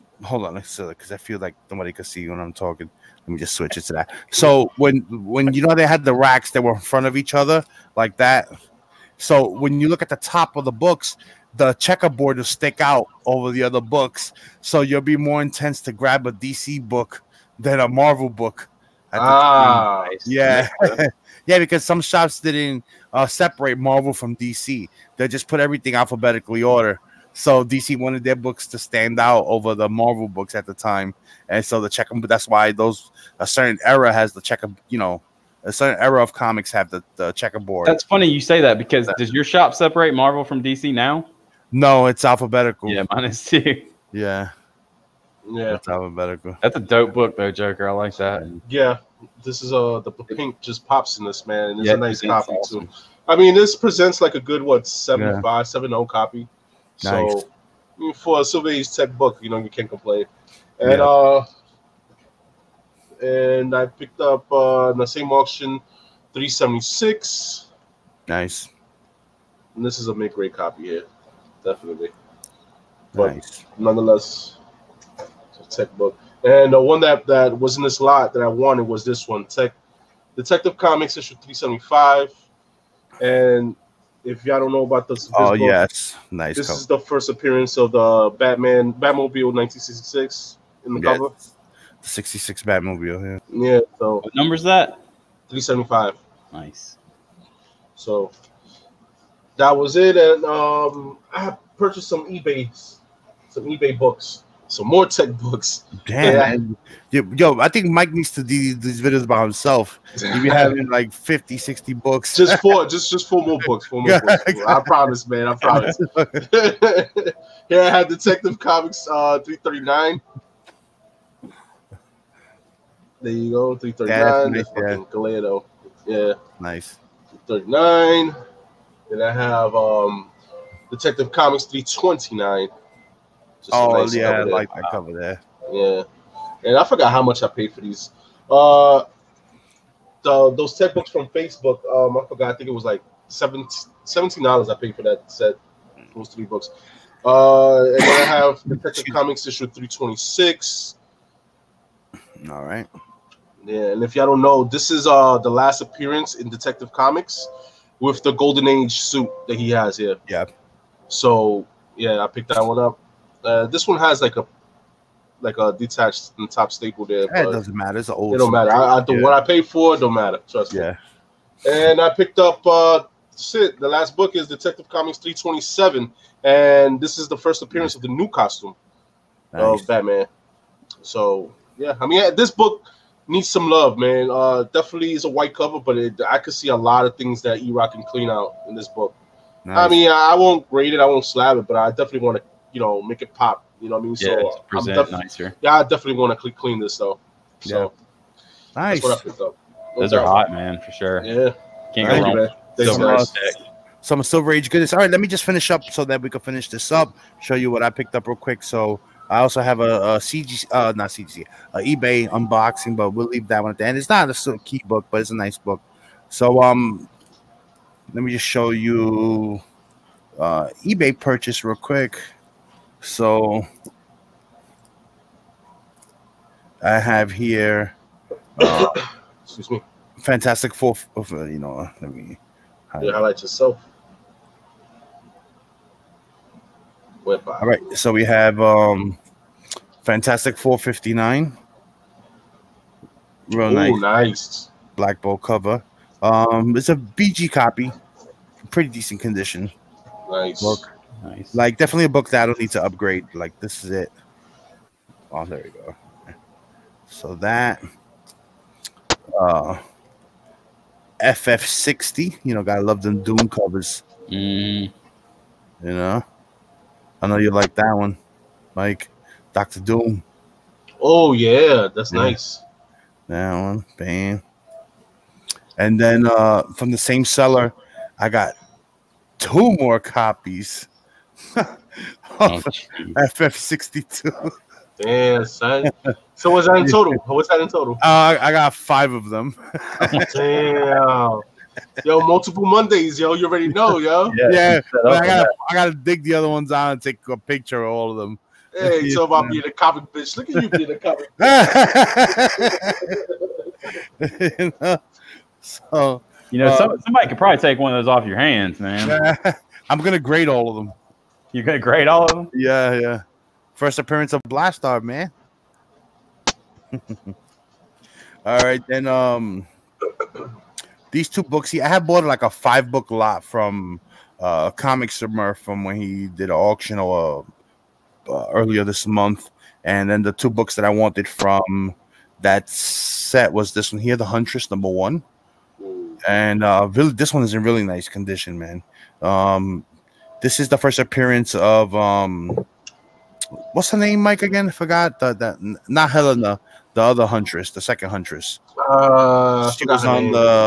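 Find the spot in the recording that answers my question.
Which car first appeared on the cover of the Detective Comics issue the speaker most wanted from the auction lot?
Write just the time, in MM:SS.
01:28.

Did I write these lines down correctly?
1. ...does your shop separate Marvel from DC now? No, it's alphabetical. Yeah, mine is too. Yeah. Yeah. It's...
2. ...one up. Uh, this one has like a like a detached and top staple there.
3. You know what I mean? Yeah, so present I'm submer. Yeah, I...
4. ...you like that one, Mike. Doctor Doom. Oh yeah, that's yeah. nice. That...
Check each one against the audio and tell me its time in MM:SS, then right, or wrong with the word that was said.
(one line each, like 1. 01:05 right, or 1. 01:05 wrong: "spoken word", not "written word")
1. 00:39 right
2. 02:42 right
3. 03:13 wrong: "nicer", not "submer"
4. 04:27 right.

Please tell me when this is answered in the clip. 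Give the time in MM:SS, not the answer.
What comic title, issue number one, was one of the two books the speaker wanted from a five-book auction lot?
05:34.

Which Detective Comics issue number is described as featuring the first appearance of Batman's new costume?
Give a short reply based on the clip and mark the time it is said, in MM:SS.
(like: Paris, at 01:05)
327, at 02:55.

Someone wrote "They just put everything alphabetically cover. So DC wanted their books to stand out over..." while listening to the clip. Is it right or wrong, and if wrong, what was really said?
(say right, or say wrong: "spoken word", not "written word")
wrong: "order", not "cover".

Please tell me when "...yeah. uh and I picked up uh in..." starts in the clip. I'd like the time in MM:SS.
01:00.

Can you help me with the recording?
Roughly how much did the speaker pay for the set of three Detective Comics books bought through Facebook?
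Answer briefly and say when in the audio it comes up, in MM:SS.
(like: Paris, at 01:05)
$17, at 02:23.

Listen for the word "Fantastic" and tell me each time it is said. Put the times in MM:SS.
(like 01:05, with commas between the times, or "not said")
03:50, 04:00.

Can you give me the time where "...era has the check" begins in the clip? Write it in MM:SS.
00:33.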